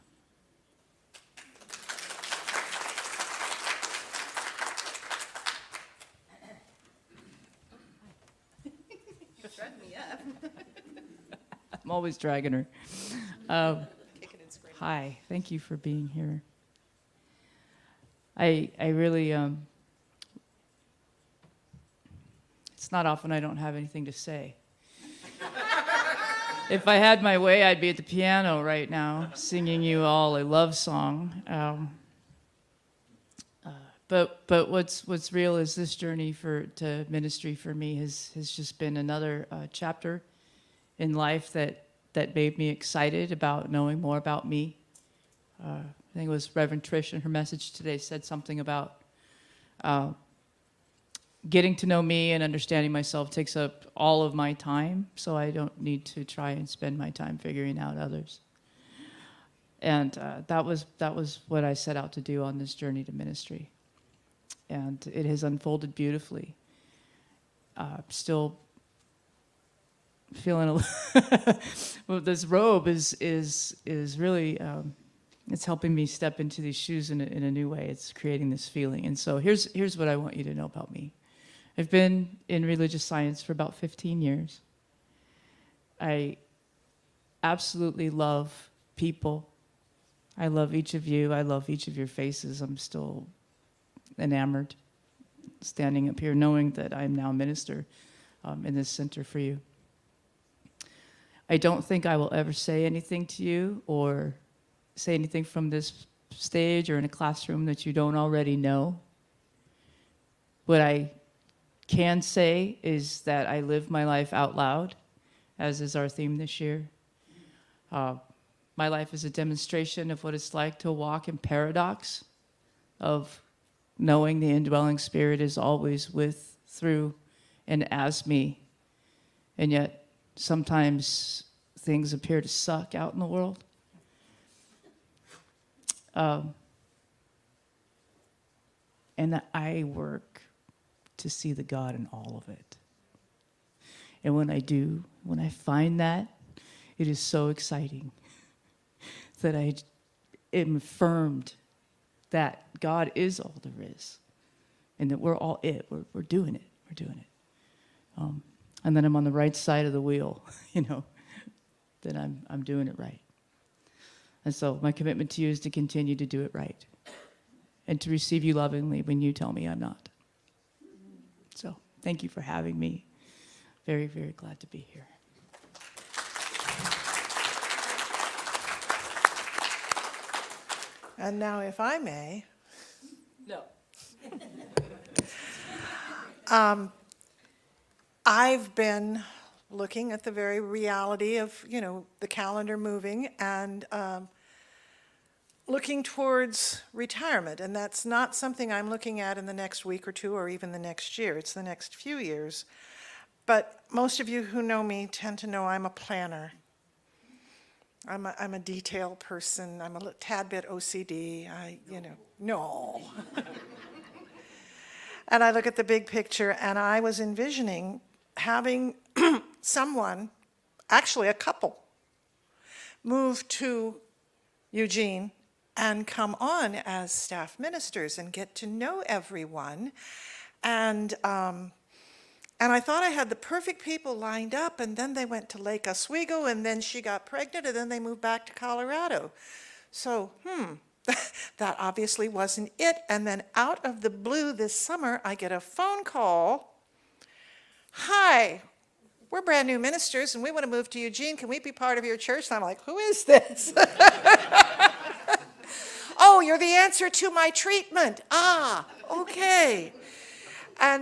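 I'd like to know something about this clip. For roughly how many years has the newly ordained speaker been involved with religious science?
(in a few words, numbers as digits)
15 years.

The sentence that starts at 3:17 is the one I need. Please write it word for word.
And that's not something I'm looking at in the next week or two or even the next year.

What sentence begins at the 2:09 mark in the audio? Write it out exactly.
And yet, sometimes things appear to suck out in the world.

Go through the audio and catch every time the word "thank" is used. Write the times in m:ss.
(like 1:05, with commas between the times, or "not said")
0:15, 2:52.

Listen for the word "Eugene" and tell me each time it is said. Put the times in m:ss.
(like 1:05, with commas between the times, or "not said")
3:44, 4:10.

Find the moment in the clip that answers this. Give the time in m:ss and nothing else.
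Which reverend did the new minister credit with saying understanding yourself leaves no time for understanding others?
0:46.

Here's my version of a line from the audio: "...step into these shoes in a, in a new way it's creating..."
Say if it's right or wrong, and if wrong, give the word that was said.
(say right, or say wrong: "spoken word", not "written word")
right.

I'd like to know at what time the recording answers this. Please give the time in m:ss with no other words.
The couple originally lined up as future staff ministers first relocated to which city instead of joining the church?
3:55.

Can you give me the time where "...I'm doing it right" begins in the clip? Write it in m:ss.
2:42.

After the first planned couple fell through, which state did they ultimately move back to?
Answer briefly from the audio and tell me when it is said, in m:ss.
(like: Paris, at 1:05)
Colorado, at 3:58.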